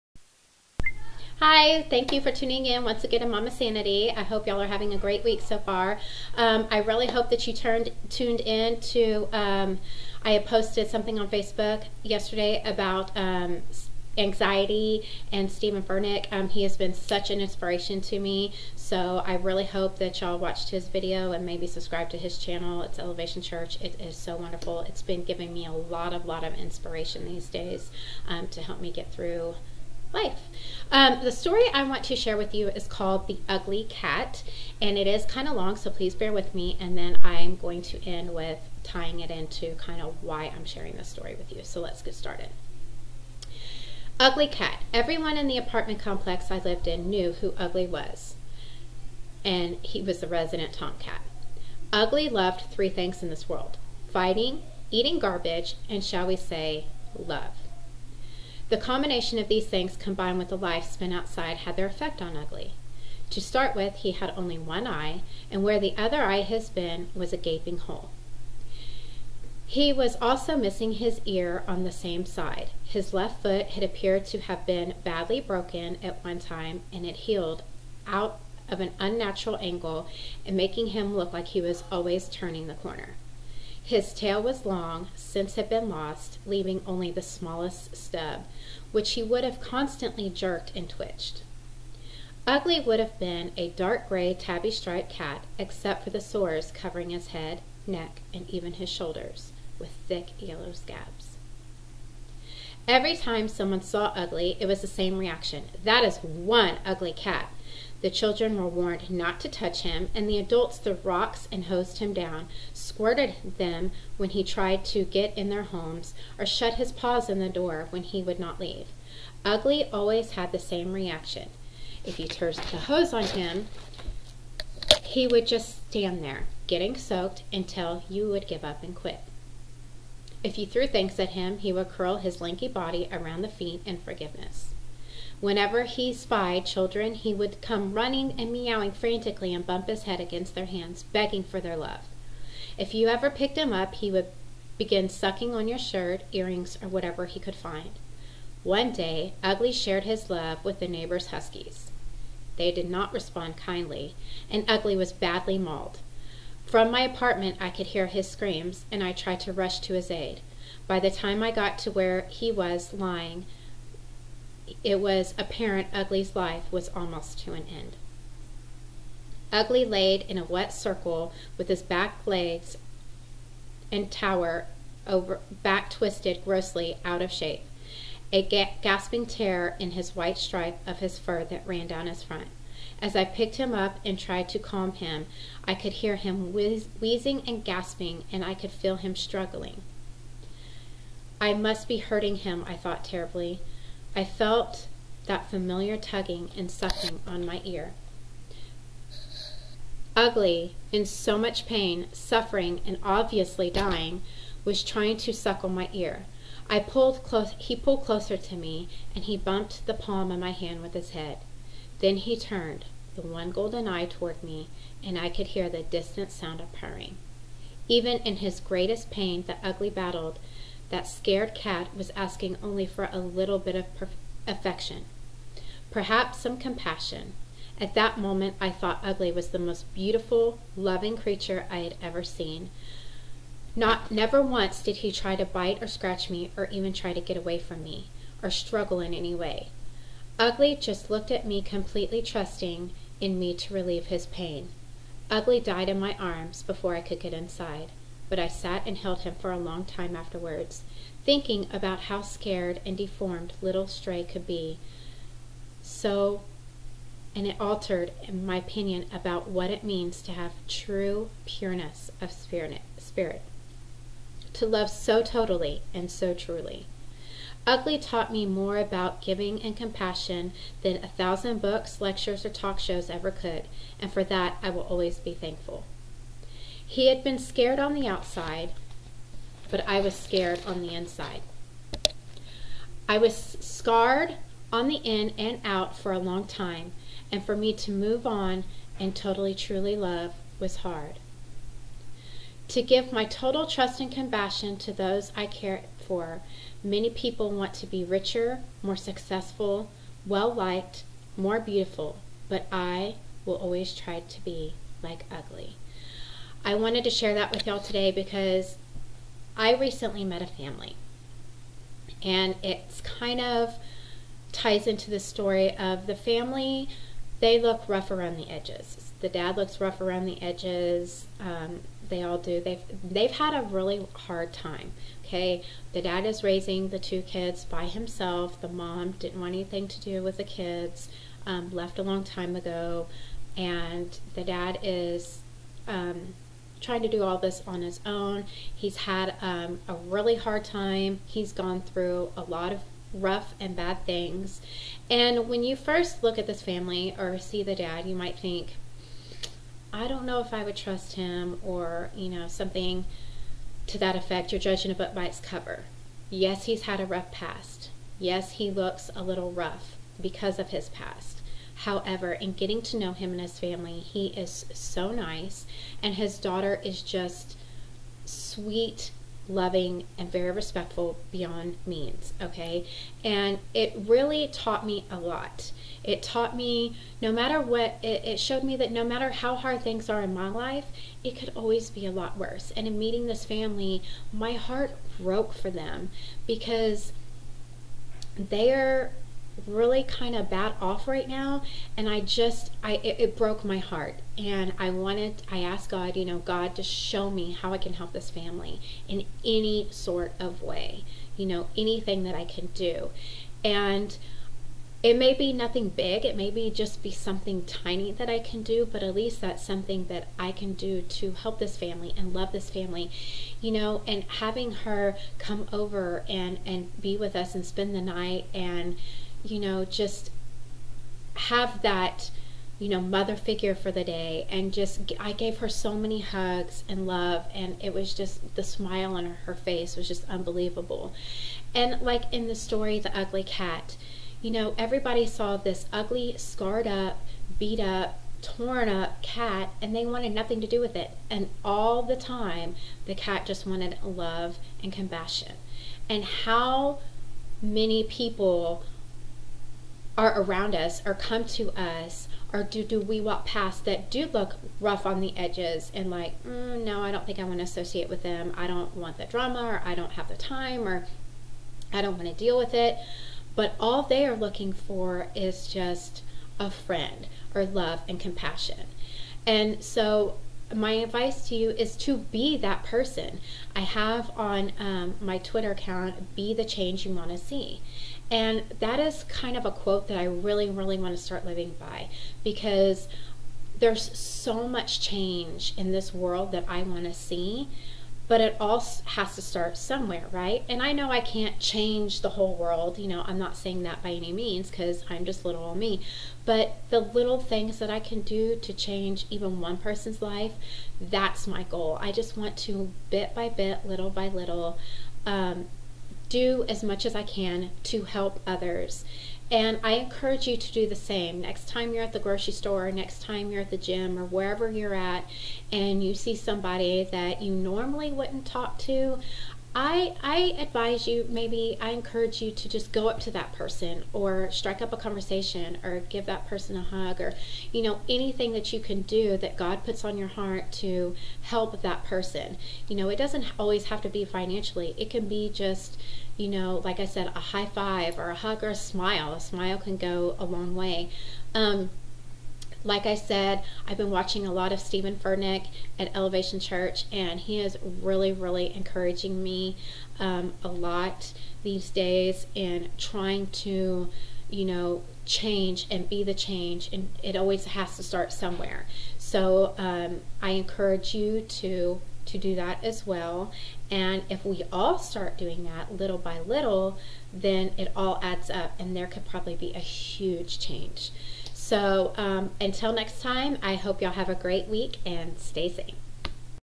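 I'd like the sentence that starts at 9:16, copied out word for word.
And it always has to start somewhere.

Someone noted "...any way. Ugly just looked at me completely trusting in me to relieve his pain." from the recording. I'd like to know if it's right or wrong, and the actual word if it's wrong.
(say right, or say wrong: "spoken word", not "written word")
right.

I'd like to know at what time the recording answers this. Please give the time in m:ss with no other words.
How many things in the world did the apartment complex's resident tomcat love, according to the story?
0:52.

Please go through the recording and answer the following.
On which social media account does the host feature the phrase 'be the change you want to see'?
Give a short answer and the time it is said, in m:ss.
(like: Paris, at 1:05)
Twitter, at 7:55.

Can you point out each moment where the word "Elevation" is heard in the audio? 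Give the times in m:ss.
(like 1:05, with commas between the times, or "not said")
0:22, 9:06.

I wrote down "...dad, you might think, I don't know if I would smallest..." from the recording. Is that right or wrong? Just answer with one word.
wrong.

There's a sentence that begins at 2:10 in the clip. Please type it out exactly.
If you threw things at him, he would curl his lanky body around the feet in forgiveness.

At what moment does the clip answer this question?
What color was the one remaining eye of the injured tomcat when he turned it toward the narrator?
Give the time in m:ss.
3:33.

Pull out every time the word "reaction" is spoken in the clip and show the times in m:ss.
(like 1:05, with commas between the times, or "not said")
1:45, 2:00.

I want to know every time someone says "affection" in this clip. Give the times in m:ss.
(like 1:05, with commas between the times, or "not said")
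3:44.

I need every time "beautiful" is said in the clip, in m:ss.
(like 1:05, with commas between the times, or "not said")
3:49, 5:01.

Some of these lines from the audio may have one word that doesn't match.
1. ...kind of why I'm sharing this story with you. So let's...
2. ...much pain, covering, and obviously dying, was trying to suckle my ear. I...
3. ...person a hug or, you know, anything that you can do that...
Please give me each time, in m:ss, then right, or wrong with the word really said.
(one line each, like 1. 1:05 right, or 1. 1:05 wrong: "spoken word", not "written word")
1. 0:39 right
2. 3:21 wrong: "suffering", not "covering"
3. 8:46 right.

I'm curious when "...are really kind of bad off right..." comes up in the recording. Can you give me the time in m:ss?
6:28.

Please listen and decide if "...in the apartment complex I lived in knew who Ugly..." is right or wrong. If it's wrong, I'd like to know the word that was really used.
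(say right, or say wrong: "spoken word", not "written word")
right.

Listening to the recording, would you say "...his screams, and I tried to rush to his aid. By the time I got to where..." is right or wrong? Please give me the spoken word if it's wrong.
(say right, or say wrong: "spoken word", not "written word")
right.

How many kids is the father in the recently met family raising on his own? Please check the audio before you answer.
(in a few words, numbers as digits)
2.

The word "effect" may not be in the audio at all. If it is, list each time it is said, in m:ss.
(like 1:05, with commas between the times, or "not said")
1:01, 5:54.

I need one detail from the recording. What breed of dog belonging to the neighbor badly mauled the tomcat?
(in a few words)
Huskies.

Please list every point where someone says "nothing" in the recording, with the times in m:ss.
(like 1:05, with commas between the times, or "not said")
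6:45, 7:20.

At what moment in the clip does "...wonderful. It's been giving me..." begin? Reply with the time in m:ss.
0:24.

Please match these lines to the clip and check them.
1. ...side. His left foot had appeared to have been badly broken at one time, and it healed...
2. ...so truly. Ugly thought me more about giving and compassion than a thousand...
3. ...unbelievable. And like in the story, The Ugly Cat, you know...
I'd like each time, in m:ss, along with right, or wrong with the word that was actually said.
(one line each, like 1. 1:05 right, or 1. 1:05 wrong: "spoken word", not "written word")
1. 1:12 right
2. 4:26 wrong: "taught", not "thought"
3. 7:10 right.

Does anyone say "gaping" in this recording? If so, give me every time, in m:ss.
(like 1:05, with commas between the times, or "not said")
1:07.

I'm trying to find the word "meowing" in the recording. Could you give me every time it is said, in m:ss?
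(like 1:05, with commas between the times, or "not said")
2:18.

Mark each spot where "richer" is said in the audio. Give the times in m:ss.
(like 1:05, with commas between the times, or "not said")
4:58.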